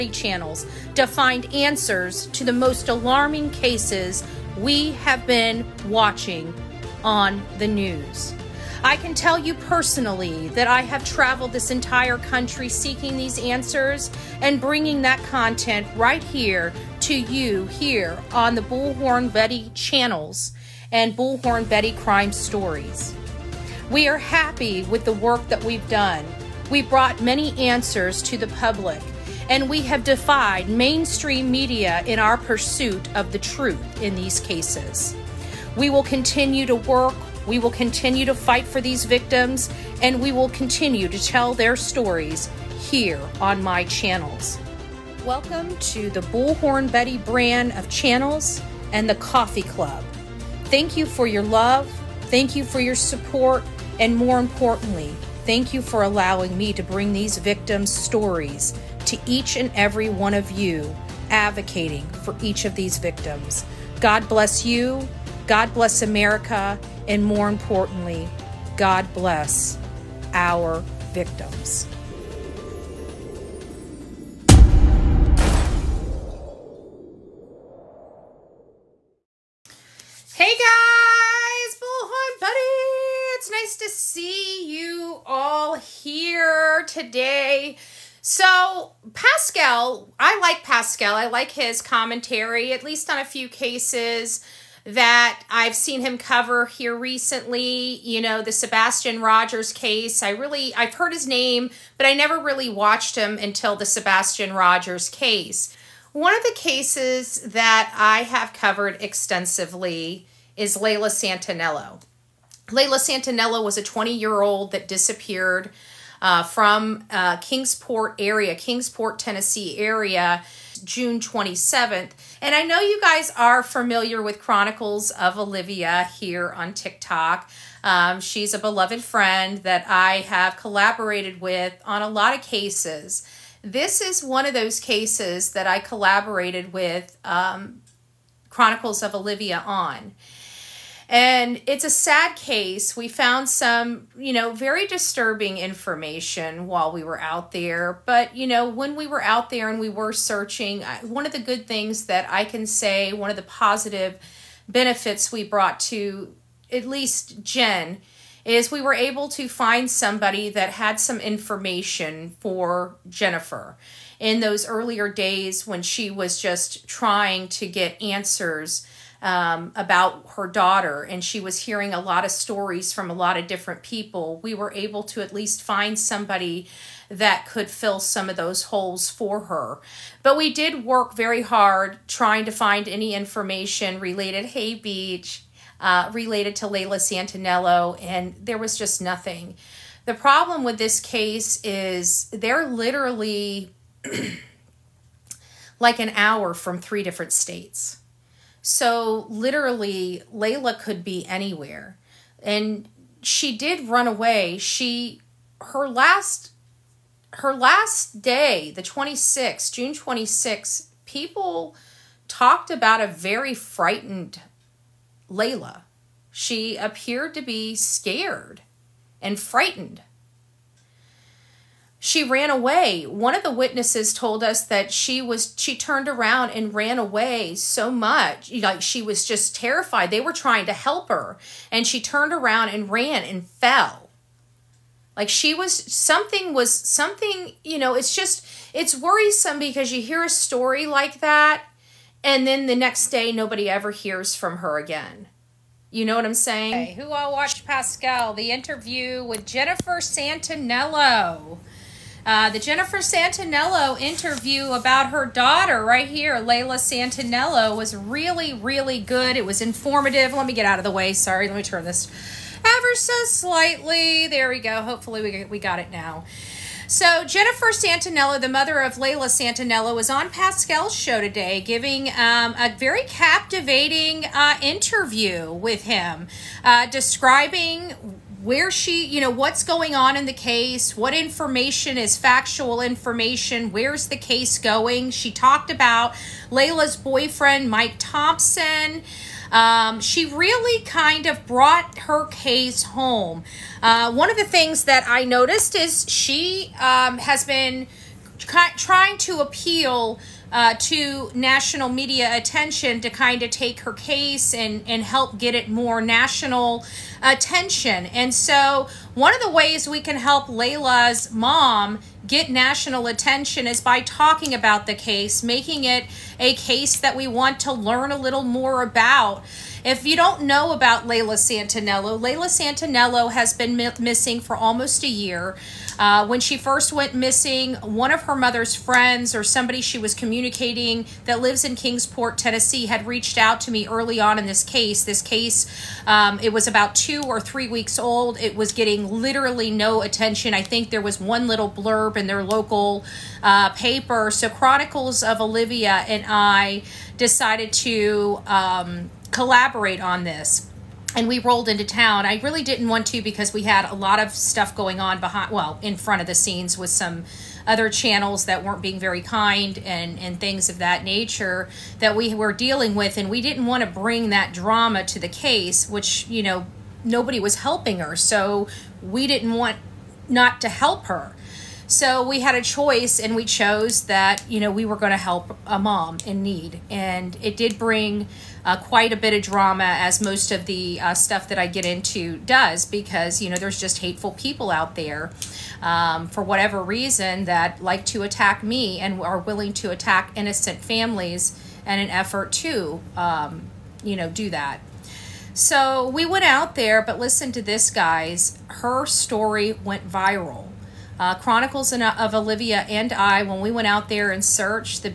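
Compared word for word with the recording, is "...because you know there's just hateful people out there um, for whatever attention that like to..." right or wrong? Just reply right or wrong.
wrong.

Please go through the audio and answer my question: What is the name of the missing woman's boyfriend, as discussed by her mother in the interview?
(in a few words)
Mike Thompson.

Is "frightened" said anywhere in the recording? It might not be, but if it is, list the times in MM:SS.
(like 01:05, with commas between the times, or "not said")
03:33, 03:39.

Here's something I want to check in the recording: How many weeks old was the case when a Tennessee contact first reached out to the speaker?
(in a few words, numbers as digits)
2 or 3 weeks.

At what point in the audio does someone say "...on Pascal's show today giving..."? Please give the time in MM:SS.
04:30.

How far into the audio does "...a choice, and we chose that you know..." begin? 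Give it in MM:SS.
06:12.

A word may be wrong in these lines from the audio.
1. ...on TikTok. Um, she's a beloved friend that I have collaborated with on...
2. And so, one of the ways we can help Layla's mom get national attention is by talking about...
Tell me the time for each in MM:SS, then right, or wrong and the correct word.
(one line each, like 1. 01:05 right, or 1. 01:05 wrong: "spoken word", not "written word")
1. 02:06 right
2. 05:08 right.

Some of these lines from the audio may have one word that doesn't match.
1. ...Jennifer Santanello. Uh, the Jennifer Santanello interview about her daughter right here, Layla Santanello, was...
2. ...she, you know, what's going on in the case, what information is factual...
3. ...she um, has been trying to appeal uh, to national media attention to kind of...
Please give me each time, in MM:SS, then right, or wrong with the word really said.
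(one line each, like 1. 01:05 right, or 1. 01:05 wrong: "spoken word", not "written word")
1. 04:09 right
2. 04:38 right
3. 04:56 right.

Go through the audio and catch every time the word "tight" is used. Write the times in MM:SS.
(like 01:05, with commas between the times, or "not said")
not said.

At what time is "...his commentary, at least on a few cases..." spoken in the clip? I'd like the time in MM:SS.
01:31.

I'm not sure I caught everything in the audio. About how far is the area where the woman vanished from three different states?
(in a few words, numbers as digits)
an hour.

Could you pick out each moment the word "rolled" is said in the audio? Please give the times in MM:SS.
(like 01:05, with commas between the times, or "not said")
05:51.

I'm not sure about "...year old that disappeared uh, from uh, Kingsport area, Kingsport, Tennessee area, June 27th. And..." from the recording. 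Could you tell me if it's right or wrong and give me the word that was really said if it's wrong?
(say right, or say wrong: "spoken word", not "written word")
right.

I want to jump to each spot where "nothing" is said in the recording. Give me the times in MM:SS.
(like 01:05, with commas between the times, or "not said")
03:09.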